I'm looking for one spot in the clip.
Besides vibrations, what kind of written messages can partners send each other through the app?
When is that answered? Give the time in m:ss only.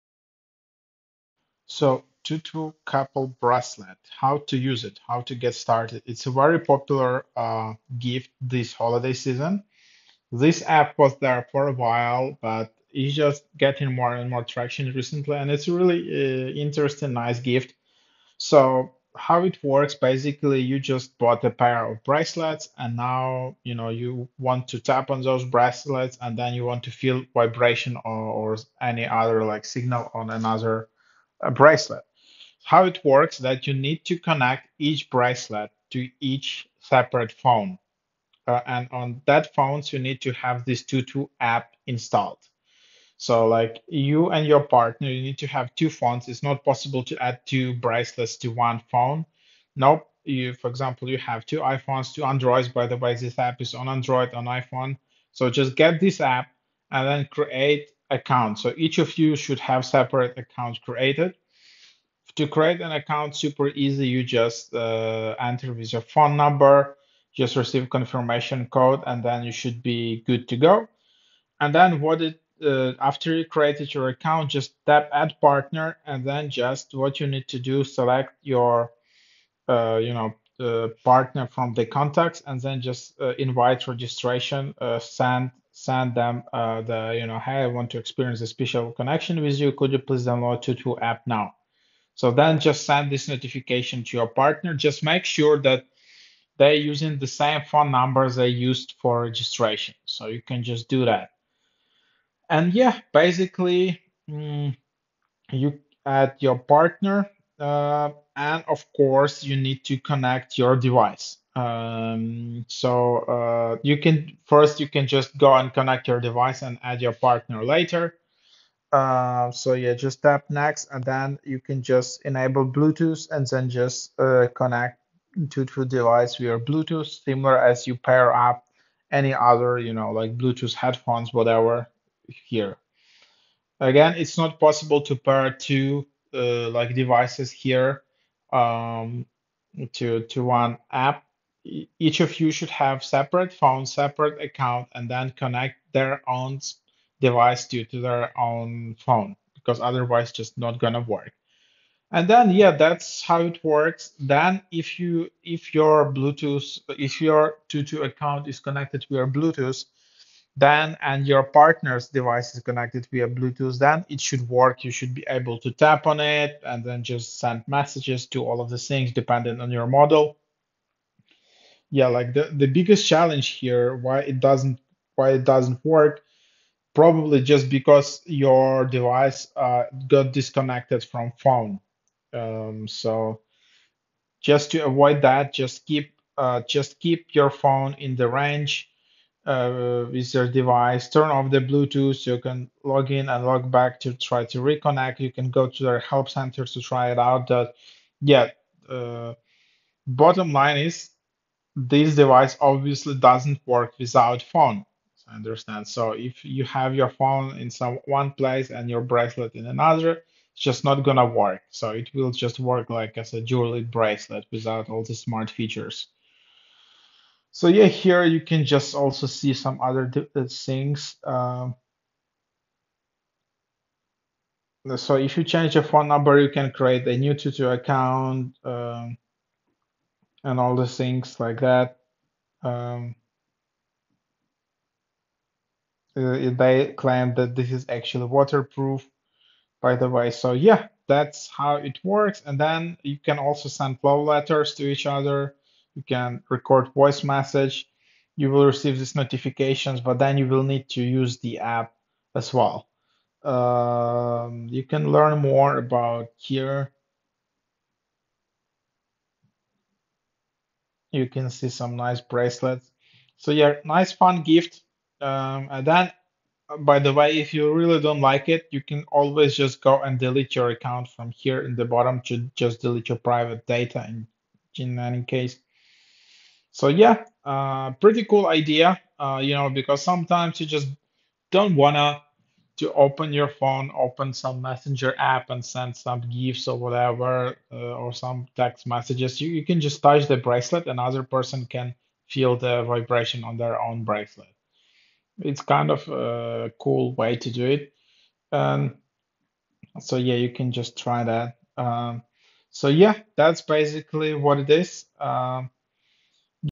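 4:04.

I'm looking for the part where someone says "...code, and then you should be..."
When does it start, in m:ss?
1:08.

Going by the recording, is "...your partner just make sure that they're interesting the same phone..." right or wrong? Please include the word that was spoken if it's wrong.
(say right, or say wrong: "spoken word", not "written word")
wrong: "using", not "interesting".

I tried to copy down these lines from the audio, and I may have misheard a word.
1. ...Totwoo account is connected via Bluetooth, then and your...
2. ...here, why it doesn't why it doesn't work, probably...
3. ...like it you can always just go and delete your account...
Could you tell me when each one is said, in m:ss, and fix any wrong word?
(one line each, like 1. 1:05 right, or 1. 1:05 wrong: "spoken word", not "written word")
1. 2:37 right
2. 2:53 right
3. 4:28 right.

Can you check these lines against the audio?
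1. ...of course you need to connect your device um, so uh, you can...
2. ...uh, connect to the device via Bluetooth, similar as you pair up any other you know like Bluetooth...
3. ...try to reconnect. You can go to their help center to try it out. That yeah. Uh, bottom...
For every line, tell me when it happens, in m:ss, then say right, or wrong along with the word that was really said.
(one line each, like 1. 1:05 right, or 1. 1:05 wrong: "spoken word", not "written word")
1. 1:48 right
2. 2:04 right
3. 3:14 right.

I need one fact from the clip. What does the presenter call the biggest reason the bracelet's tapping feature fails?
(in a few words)
Disconnected from phone.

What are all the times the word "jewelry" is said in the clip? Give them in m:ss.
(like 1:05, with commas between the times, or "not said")
3:33.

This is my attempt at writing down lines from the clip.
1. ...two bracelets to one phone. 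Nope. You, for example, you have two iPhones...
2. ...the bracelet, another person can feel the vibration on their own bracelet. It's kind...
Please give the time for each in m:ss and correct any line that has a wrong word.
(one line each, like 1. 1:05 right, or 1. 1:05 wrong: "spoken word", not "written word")
1. 0:47 right
2. 4:50 right.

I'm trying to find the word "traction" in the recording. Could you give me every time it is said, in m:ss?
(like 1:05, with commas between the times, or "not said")
0:14.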